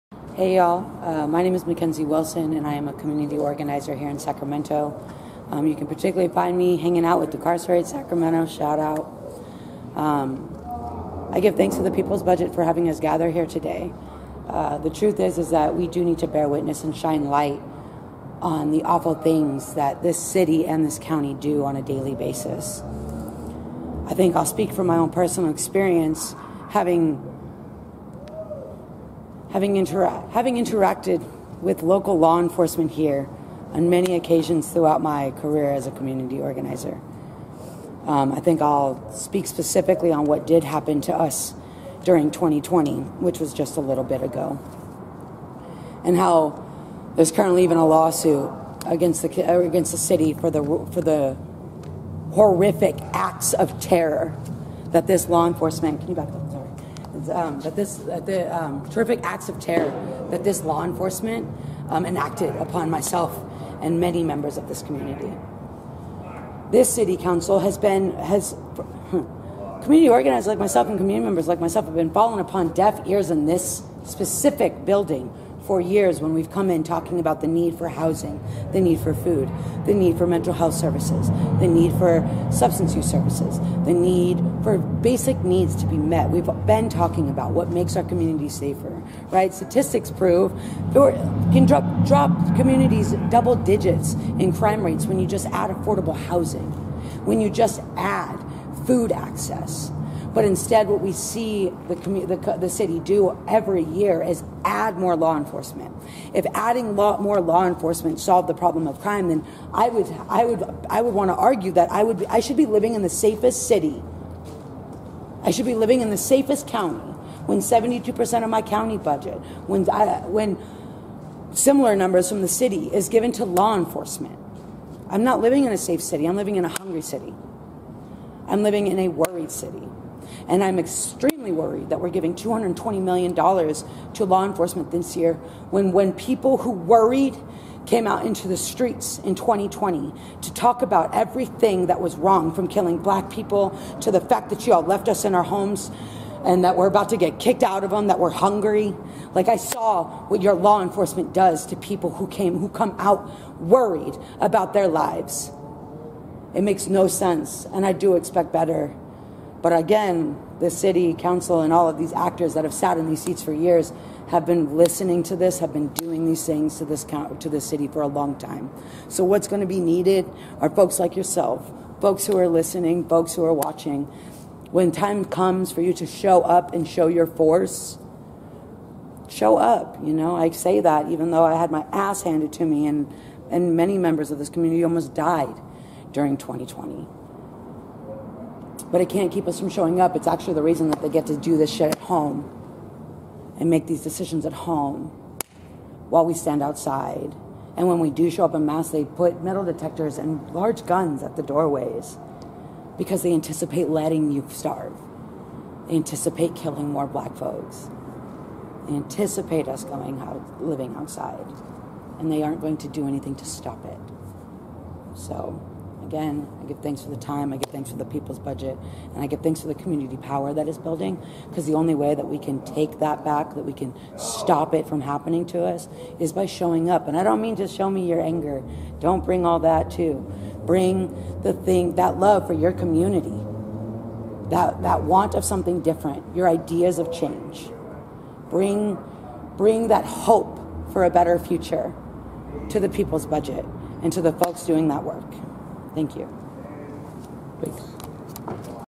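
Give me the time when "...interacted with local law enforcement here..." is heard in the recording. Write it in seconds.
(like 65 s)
30 s.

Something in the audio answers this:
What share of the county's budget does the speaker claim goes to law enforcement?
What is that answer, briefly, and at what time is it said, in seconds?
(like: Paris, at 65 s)
72%, at 117 s.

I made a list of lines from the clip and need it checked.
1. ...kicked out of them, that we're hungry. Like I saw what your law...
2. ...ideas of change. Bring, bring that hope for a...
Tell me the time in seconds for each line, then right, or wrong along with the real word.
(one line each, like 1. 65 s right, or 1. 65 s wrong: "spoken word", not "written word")
1. 147 s right
2. 236 s right.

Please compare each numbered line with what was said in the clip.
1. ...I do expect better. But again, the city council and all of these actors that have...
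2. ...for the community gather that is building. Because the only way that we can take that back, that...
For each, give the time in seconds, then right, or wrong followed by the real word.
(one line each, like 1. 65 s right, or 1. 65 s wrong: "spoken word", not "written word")
1. 157 s right
2. 219 s wrong: "power", not "gather".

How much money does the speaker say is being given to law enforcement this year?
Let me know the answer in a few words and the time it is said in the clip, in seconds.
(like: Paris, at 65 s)
$220 million, at 132 s.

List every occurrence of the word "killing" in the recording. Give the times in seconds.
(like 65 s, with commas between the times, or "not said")
142 s, 206 s.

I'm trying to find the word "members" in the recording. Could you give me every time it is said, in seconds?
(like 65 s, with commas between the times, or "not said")
64 s, 71 s, 183 s.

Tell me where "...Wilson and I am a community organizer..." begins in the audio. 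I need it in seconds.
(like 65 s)
2 s.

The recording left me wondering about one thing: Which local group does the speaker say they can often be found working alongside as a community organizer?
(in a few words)
Decarcerate Sacramento.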